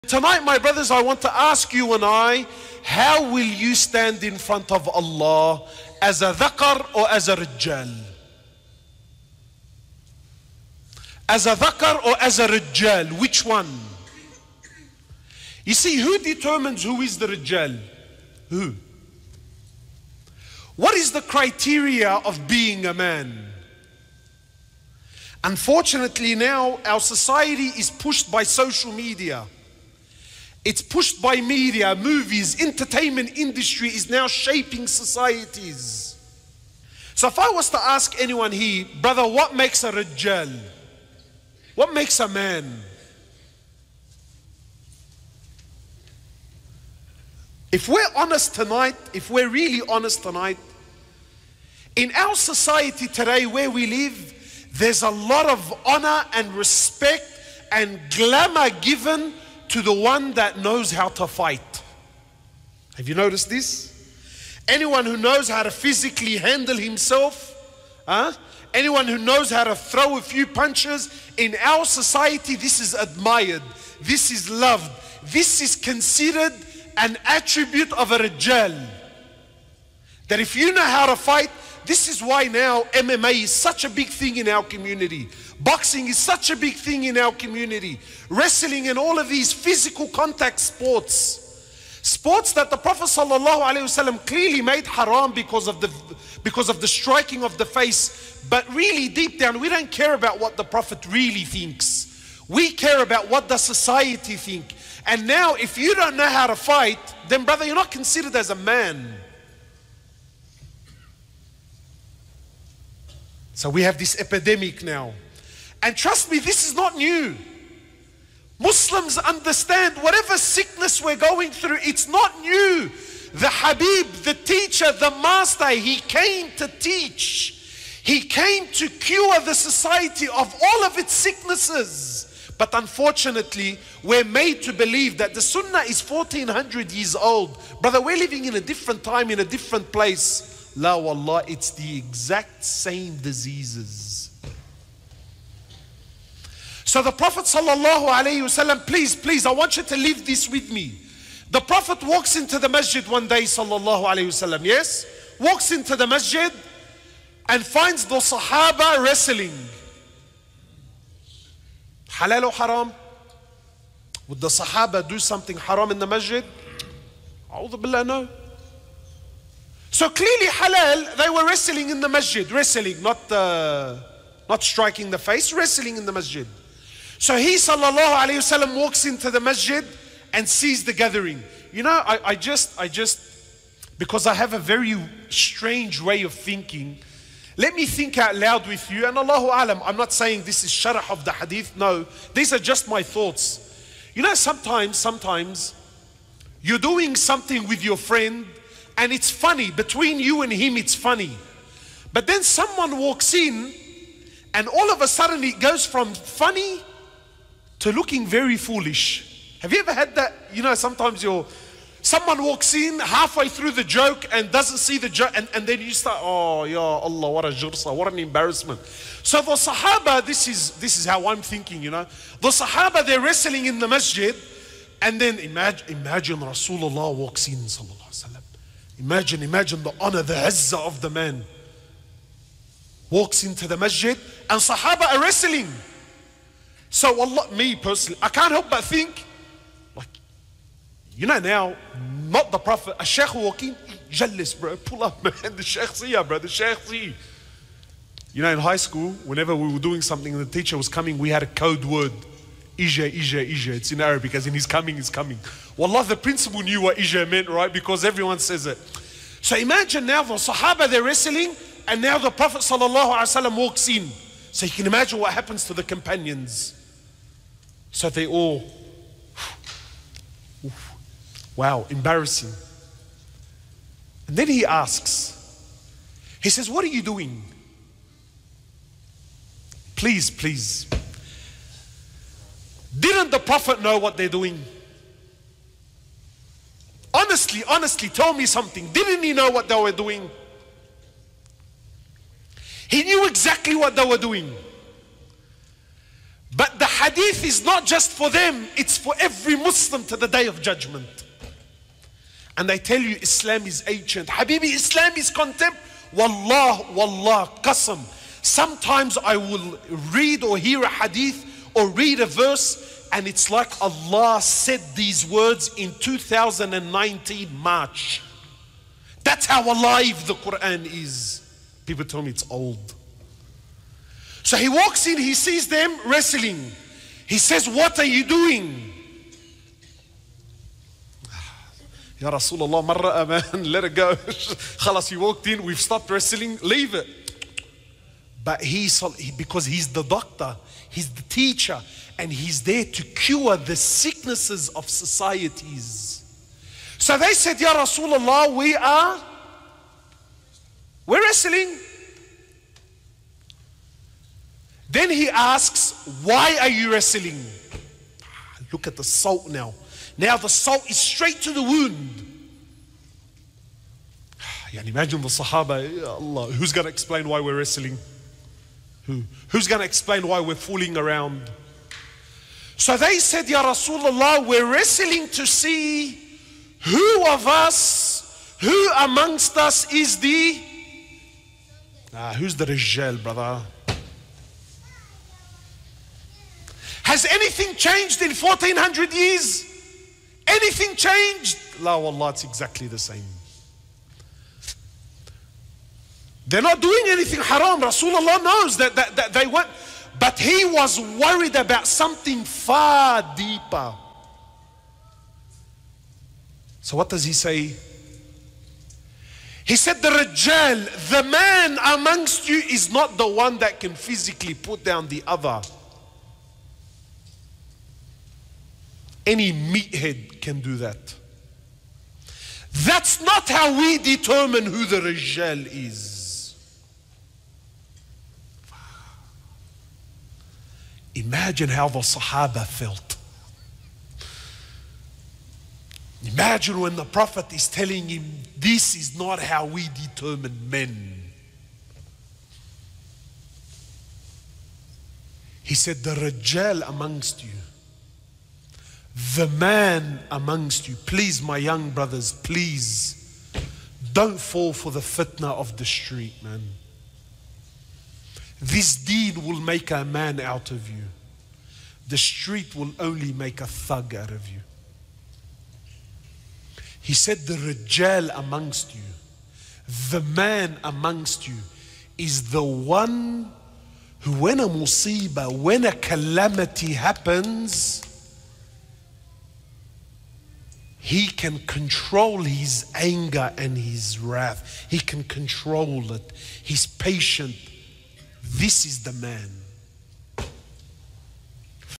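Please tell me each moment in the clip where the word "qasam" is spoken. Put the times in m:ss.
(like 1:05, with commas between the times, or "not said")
5:07.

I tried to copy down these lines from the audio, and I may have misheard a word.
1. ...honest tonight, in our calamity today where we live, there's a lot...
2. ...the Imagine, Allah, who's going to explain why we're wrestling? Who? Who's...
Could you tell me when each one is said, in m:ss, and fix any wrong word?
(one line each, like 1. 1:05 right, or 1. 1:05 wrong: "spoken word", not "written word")
1. 0:49 wrong: "society", not "calamity"
2. 6:05 wrong: "Sahaba", not "Imagine".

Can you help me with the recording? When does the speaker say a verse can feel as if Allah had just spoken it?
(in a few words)
March 2019.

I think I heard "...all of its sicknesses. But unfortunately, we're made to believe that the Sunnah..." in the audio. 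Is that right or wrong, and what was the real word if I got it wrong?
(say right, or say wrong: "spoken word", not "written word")
right.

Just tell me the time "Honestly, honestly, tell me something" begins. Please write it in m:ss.
4:47.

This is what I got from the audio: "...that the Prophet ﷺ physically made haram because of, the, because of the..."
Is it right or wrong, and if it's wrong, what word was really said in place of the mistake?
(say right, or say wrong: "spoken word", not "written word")
wrong: "clearly", not "physically".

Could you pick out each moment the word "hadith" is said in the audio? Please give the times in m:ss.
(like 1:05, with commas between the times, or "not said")
3:11, 4:57, 5:10.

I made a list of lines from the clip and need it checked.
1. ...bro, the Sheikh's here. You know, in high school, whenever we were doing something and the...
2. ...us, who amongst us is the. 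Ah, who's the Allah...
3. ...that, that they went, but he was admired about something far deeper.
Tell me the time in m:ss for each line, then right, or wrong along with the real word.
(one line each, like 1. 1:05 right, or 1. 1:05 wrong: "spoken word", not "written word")
1. 4:06 right
2. 6:17 wrong: "Rijal", not "Allah"
3. 6:38 wrong: "worried", not "admired".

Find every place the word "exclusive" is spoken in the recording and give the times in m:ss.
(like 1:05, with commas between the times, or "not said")
not said.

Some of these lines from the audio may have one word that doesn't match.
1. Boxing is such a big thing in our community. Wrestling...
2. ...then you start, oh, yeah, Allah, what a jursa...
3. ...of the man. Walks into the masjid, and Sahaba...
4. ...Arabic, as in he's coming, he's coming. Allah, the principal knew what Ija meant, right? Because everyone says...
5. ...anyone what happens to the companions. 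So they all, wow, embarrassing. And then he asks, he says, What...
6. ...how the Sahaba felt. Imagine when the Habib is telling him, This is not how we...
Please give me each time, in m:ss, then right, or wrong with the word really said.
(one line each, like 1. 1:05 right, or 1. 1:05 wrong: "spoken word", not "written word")
1. 1:25 right
2. 3:35 right
3. 3:50 right
4. 4:14 right
5. 4:24 wrong: "imagine", not "anyone"
6. 7:11 wrong: "Prophet", not "Habib".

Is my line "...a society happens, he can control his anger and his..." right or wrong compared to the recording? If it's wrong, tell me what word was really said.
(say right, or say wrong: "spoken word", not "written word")
wrong: "calamity", not "society".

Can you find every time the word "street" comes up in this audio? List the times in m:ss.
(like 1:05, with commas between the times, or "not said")
7:35, 7:42.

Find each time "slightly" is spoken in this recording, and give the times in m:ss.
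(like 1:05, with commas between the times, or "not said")
not said.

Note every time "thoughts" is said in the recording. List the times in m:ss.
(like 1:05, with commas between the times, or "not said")
3:13.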